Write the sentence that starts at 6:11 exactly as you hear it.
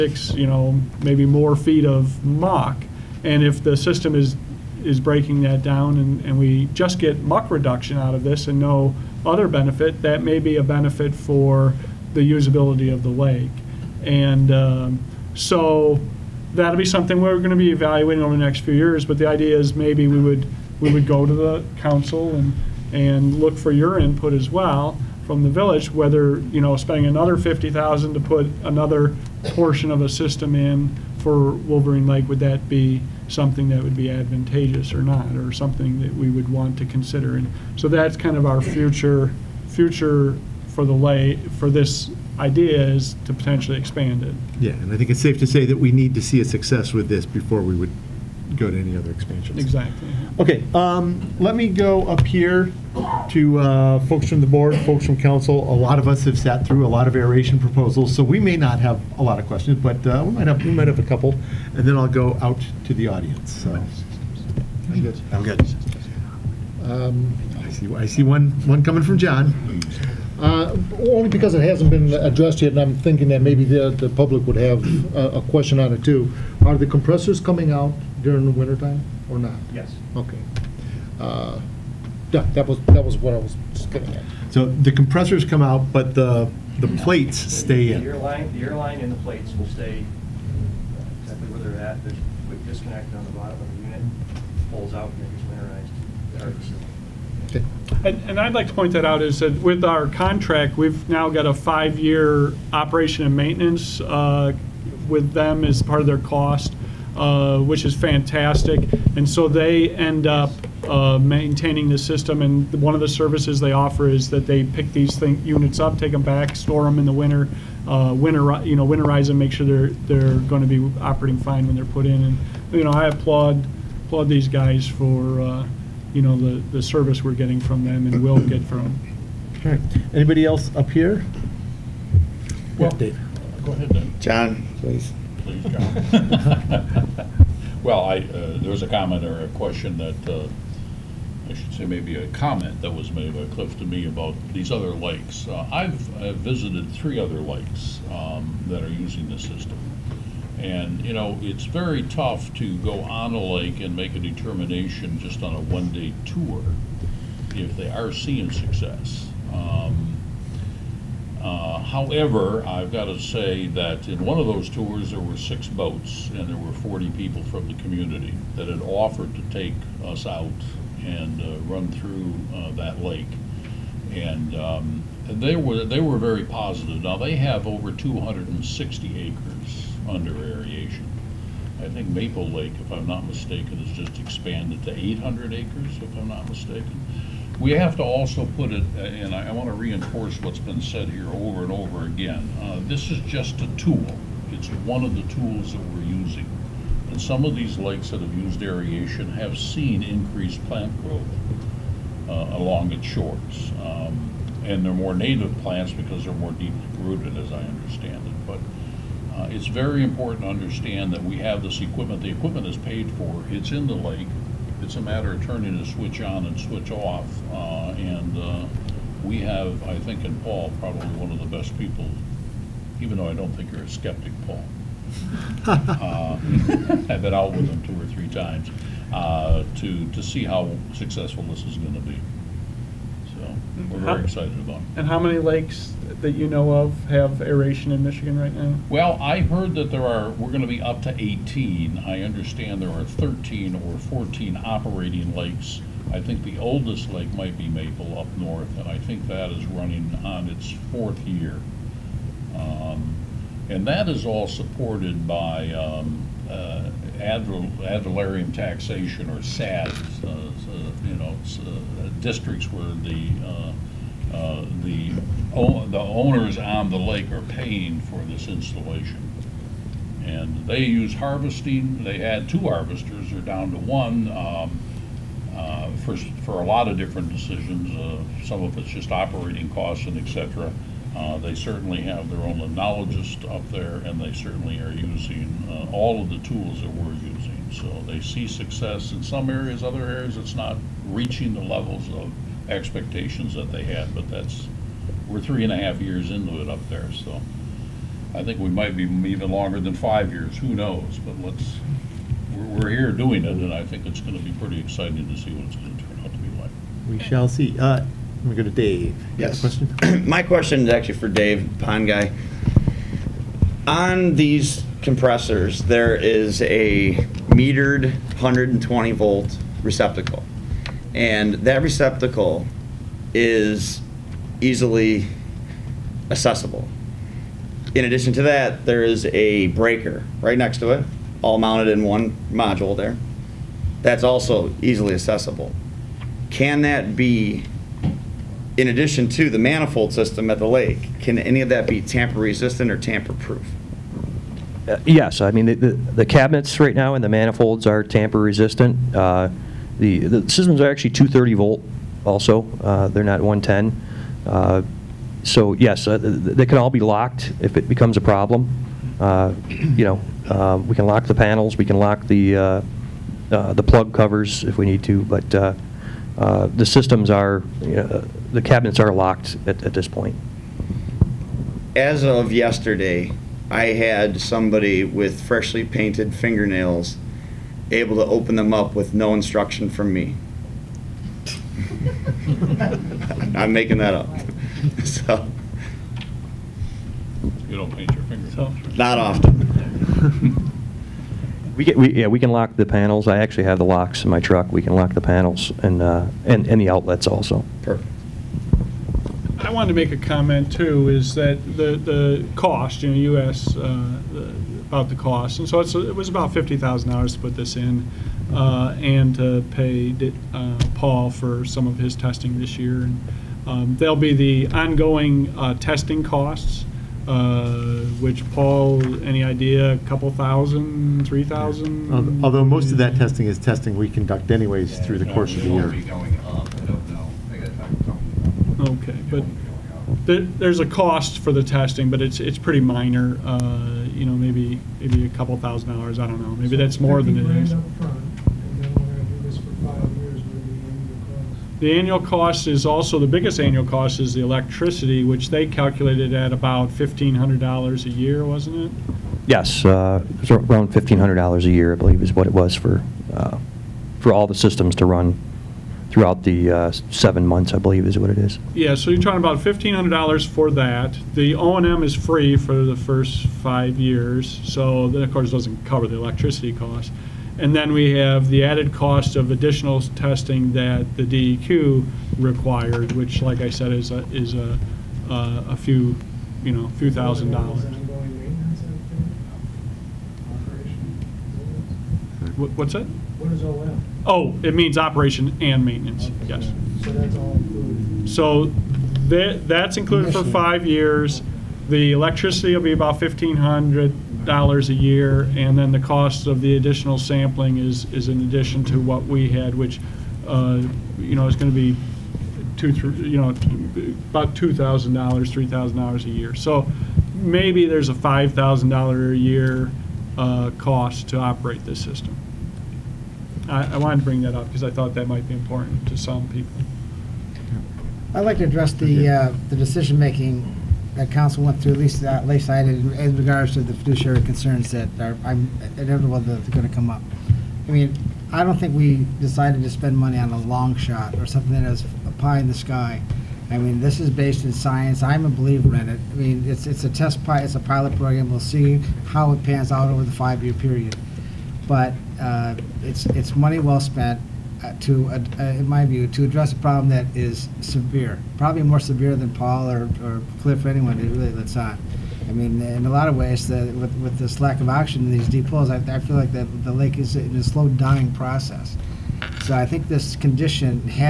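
As of yesterday, I had somebody with freshly painted fingernails able to open them up with no instruction from me.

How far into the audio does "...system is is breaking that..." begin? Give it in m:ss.
0:03.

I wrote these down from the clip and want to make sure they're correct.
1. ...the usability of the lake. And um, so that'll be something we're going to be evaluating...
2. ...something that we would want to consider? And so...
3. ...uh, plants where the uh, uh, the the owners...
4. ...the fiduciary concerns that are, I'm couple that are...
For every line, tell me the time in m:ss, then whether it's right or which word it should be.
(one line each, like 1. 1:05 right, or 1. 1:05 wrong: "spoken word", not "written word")
1. 0:12 right
2. 0:35 right
3. 4:21 wrong: "districts", not "plants"
4. 8:43 wrong: "inevitable", not "couple".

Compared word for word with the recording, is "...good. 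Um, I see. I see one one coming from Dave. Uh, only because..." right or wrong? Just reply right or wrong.
wrong.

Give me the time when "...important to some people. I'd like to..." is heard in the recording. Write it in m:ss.
8:35.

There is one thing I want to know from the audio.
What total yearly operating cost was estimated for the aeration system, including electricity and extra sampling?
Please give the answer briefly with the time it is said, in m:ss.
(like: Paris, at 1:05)
$5,000, at 8:28.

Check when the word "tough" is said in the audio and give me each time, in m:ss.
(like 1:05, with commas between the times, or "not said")
2:32.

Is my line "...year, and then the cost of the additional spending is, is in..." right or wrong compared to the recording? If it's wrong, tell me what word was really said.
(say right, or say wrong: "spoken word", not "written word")
wrong: "sampling", not "spending".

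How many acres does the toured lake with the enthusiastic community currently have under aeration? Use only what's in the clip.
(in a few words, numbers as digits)
260 acres.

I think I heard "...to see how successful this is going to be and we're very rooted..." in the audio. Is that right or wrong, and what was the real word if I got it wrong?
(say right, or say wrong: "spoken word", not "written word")
wrong: "excited", not "rooted".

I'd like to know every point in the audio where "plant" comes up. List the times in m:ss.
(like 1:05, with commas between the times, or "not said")
3:20, 3:25.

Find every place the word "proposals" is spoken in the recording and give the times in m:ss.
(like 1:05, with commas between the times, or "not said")
0:57.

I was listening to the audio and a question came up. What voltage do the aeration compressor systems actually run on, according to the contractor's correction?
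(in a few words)
230 volts.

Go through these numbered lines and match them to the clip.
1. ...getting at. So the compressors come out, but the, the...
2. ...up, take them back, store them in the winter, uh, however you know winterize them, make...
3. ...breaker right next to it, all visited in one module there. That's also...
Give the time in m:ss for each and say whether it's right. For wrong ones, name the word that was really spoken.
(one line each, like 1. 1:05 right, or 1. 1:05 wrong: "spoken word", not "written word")
1. 1:23 right
2. 1:55 wrong: "winter", not "however"
3. 5:29 wrong: "mounted", not "visited".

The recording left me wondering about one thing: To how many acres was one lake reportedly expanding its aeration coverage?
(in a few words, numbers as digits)
800 acres.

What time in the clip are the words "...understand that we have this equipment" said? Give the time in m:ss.
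3:30.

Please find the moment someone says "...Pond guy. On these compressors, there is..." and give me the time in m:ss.
5:11.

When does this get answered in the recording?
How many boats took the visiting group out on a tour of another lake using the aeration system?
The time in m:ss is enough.
2:45.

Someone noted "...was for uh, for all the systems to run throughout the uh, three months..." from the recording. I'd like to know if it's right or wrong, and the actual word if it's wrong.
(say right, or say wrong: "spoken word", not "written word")
wrong: "seven", not "three".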